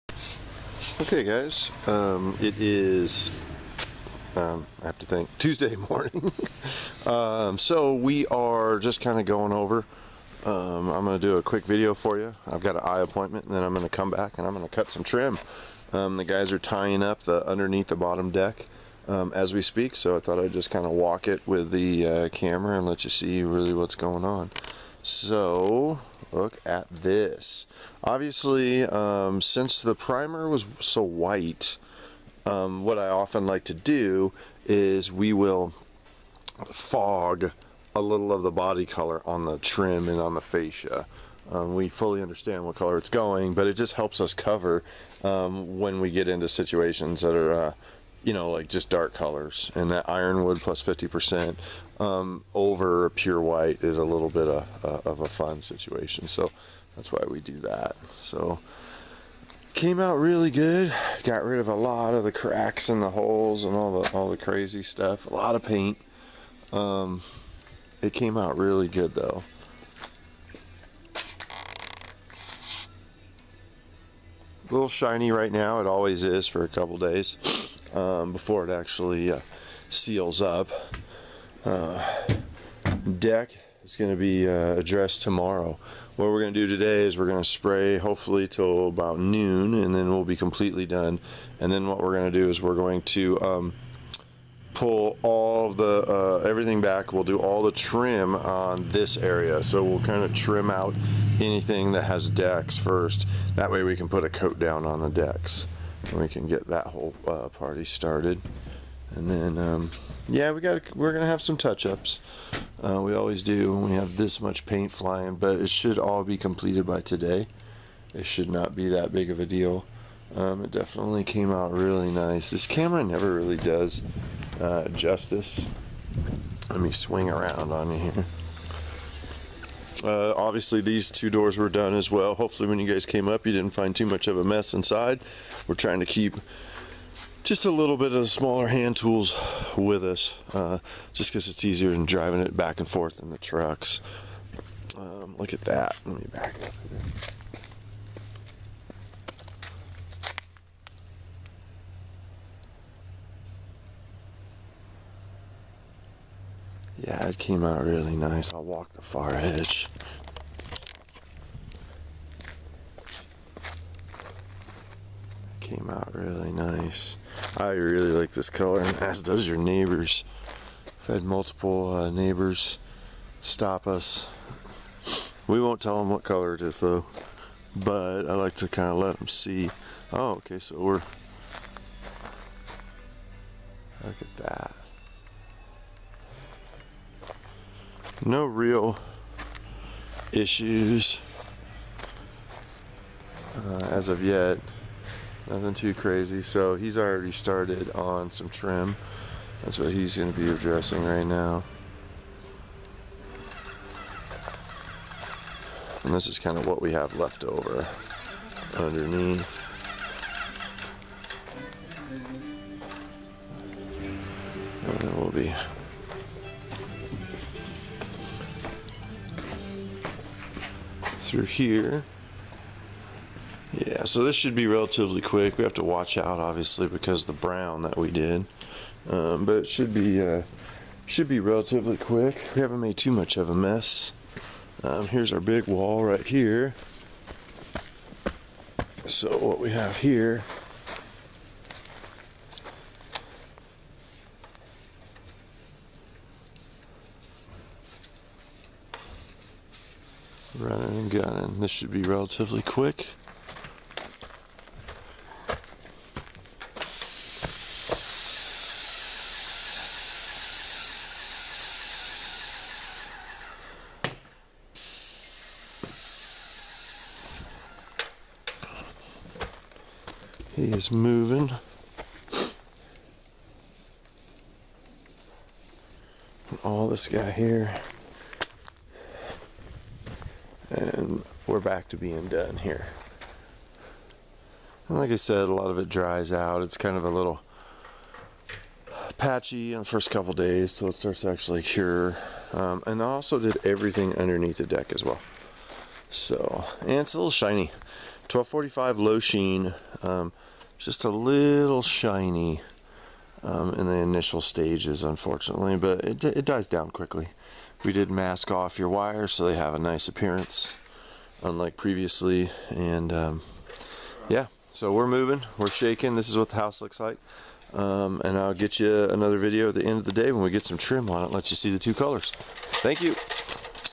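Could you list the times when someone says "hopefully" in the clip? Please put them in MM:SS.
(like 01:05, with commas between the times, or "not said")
01:27, 02:12.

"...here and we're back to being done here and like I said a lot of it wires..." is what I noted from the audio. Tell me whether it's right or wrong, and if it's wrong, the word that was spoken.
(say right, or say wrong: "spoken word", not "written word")
wrong: "dries", not "wires".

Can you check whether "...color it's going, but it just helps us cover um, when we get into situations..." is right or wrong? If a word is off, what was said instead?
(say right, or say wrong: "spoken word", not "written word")
right.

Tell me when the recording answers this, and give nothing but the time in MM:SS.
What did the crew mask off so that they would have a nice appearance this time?
05:08.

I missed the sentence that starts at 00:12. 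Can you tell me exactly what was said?
I've got an eye appointment, and then I'm going to come back and I'm going to cut some trim.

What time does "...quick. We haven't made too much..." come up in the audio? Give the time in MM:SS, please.
03:51.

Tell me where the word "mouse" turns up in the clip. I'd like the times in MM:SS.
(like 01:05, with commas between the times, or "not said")
not said.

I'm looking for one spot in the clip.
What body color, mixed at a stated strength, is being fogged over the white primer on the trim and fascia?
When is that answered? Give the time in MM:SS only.
00:50.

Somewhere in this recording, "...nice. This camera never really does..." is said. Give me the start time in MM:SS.
02:02.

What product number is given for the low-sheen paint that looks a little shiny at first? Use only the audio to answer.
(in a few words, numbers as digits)
1245.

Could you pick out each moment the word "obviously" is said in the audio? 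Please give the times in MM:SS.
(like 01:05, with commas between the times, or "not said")
00:28, 02:10, 03:46.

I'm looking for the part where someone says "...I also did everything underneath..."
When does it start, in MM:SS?
04:53.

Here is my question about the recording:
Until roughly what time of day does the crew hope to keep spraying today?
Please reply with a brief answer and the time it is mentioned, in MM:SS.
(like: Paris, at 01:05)
Noon, at 01:29.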